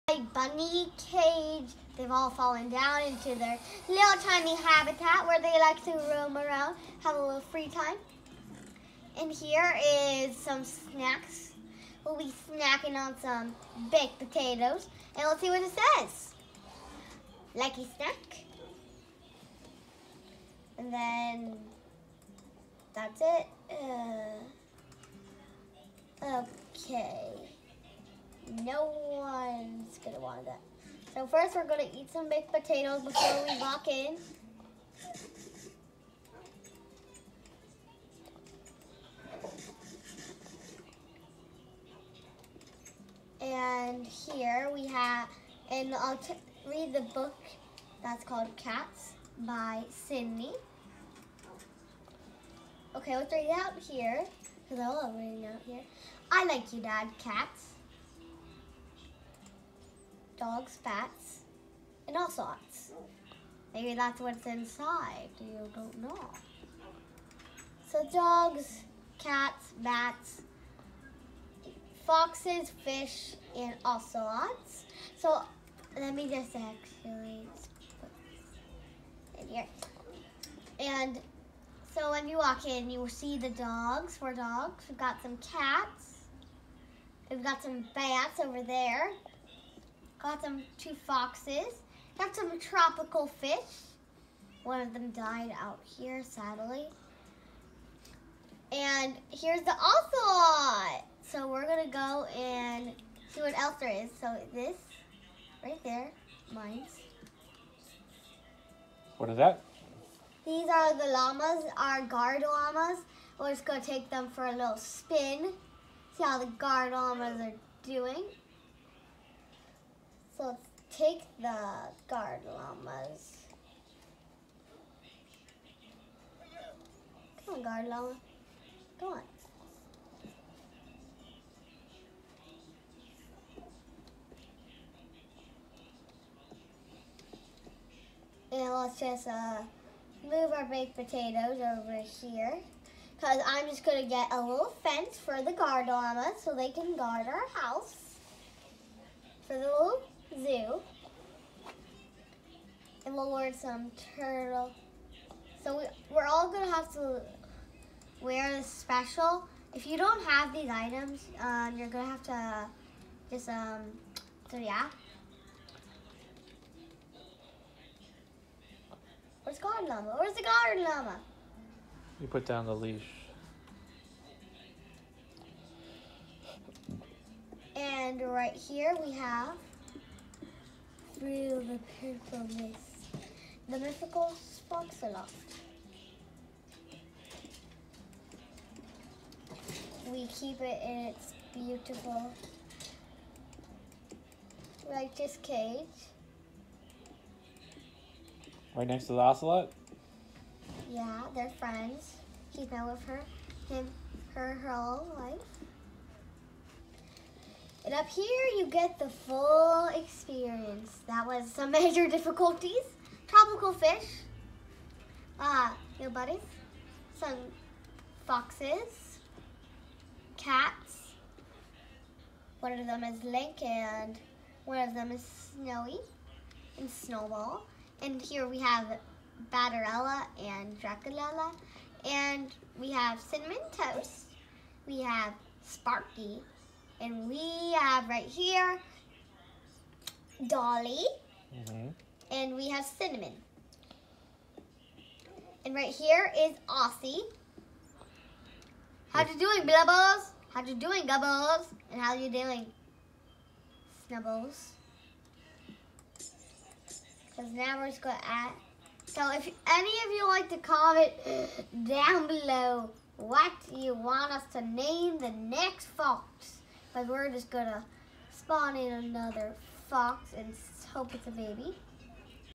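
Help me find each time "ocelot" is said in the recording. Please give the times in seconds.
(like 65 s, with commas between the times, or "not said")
73 s, 99 s, 199 s.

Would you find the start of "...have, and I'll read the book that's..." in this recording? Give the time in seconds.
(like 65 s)
44 s.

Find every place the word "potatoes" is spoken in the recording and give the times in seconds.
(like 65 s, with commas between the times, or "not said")
14 s, 32 s, 140 s.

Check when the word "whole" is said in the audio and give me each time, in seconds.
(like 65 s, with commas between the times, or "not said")
204 s.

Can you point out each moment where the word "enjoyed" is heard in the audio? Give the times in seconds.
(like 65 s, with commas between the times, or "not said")
not said.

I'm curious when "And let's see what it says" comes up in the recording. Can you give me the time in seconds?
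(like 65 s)
15 s.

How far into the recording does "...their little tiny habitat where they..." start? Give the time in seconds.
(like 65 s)
3 s.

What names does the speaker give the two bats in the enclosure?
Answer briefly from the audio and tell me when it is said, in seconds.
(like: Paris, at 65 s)
Batterella and Draculella, at 229 s.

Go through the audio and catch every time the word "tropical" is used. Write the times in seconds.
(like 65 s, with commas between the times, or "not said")
92 s, 213 s.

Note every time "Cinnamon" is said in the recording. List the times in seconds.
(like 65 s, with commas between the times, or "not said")
233 s, 242 s.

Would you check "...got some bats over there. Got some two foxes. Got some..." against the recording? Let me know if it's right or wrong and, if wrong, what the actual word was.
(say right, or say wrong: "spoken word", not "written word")
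right.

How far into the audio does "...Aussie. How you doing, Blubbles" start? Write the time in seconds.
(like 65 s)
246 s.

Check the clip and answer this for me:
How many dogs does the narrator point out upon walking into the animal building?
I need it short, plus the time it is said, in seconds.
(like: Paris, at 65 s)
4, at 84 s.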